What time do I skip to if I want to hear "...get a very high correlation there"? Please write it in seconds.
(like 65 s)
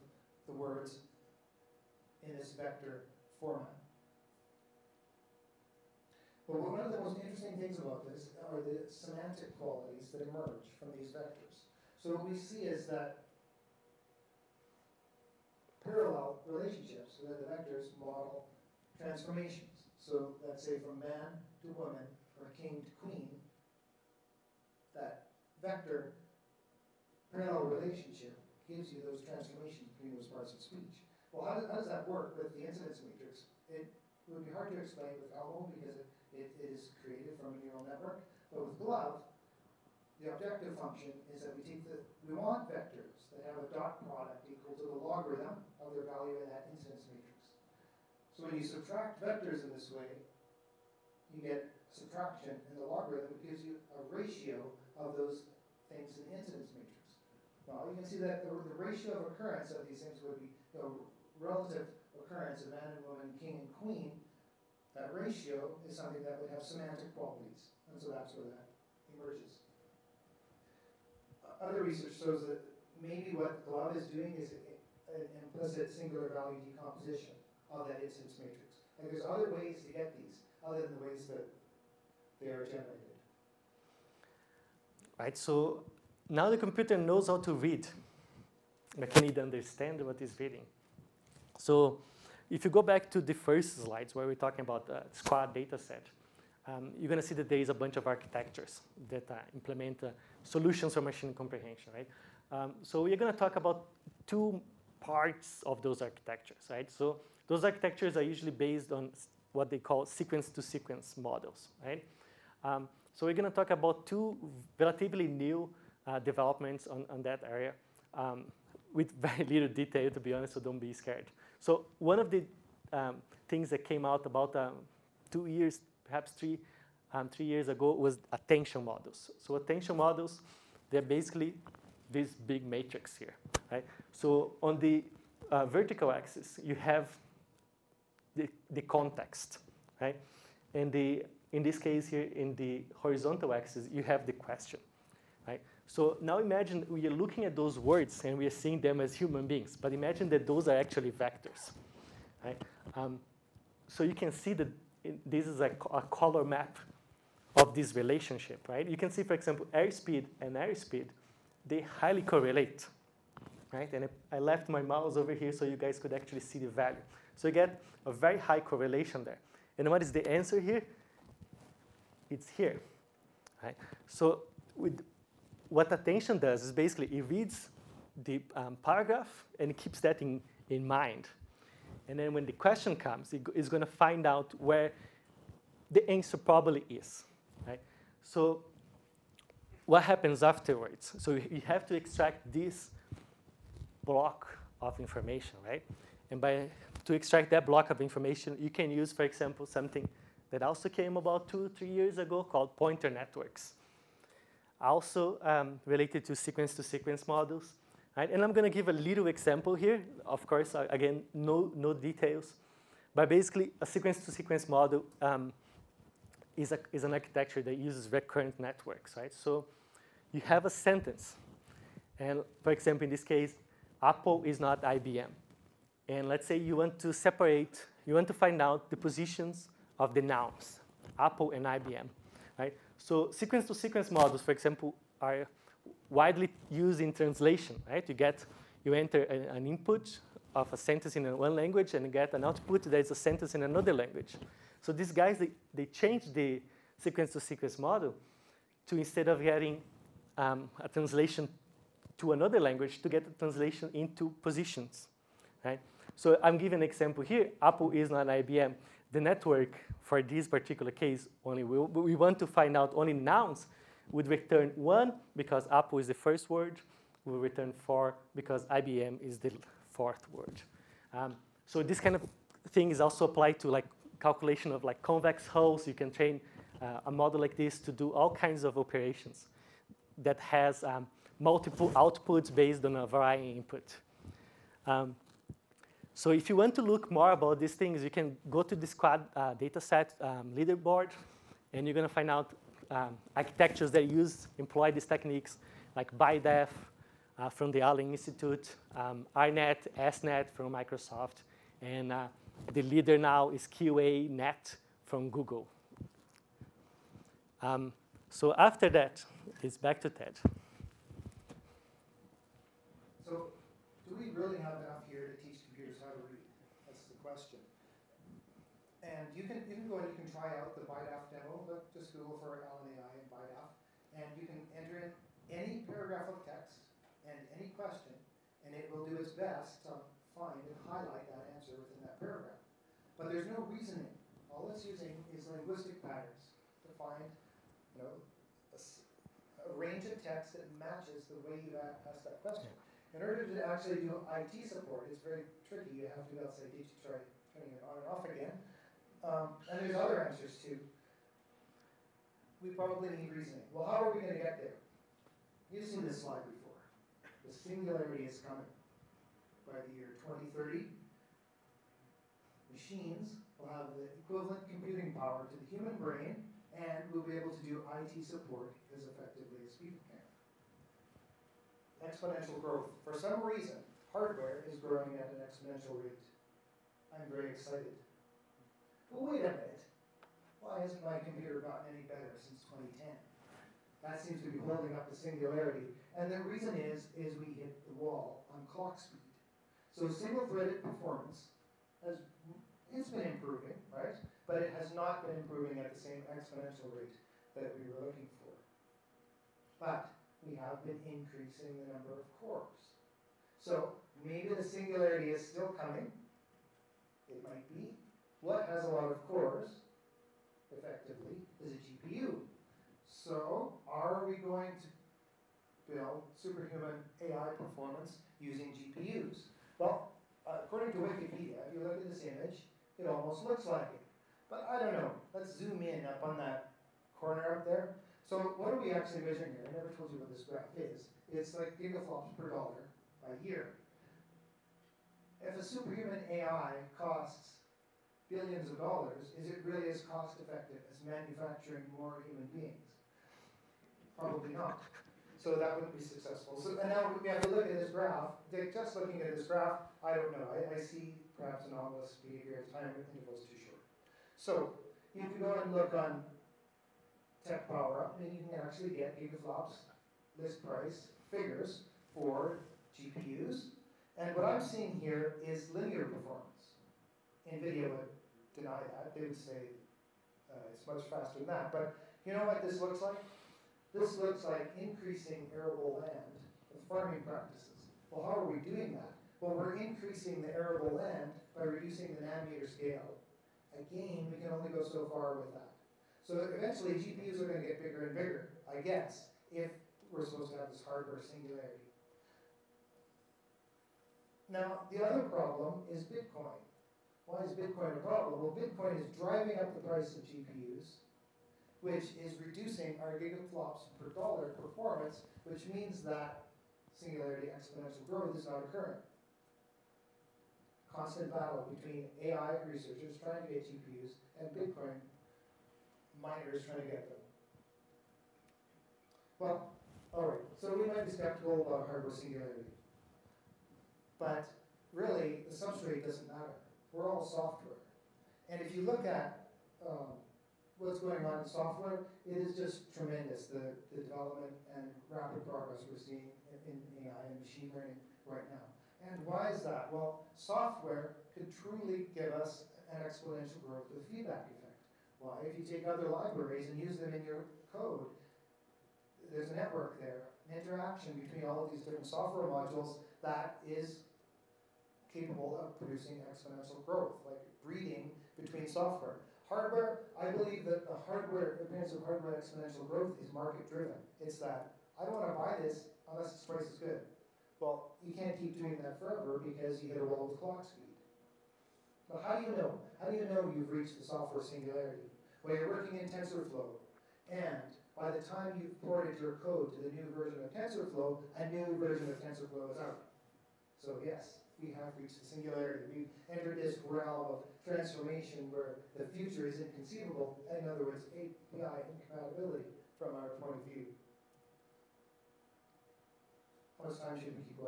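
167 s.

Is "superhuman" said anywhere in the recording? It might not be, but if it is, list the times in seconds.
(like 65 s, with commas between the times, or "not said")
416 s, 435 s.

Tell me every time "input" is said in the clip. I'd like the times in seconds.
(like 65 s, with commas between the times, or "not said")
239 s, 283 s.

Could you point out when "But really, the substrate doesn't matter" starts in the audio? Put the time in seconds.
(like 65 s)
524 s.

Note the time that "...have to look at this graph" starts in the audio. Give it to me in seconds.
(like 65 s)
447 s.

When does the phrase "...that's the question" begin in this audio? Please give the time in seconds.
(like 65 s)
316 s.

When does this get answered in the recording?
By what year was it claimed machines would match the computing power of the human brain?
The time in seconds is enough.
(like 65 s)
360 s.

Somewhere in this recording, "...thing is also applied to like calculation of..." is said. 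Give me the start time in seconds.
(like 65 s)
272 s.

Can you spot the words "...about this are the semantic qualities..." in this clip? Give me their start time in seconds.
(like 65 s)
7 s.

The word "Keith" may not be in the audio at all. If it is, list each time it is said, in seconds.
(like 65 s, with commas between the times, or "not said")
not said.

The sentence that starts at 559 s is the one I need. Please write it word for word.
Hardware, I believe that the hardware, appearance of hardware exponential growth is market driven.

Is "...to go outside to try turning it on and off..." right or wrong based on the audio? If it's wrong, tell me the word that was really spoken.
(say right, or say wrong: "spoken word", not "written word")
right.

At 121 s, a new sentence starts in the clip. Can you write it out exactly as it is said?
So one of the um, things that came out about um, two years, perhaps three, um, three years ago was attention models.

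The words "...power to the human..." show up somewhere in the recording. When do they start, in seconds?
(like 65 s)
365 s.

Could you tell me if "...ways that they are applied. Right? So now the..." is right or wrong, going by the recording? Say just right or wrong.
wrong.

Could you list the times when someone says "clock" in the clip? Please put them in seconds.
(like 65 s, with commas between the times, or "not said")
388 s, 570 s.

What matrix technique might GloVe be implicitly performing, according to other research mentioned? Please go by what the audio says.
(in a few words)
singular value decomposition.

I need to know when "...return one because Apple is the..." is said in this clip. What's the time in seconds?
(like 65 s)
264 s.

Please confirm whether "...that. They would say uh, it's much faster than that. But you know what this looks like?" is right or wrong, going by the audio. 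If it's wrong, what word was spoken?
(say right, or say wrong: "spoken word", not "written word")
right.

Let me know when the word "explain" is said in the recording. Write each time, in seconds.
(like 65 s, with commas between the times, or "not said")
34 s.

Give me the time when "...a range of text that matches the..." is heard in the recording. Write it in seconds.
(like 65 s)
339 s.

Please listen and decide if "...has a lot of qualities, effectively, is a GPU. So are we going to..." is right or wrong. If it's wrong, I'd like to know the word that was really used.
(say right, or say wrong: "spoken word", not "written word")
wrong: "cores", not "qualities".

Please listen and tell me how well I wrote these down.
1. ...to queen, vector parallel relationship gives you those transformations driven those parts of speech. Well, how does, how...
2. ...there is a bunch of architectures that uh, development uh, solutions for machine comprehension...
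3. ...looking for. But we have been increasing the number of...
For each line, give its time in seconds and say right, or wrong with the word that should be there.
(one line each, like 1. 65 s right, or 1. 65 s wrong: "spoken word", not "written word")
1. 22 s wrong: "between", not "driven"
2. 97 s wrong: "implement", not "development"
3. 398 s right.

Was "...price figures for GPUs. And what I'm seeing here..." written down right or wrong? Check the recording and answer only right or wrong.
right.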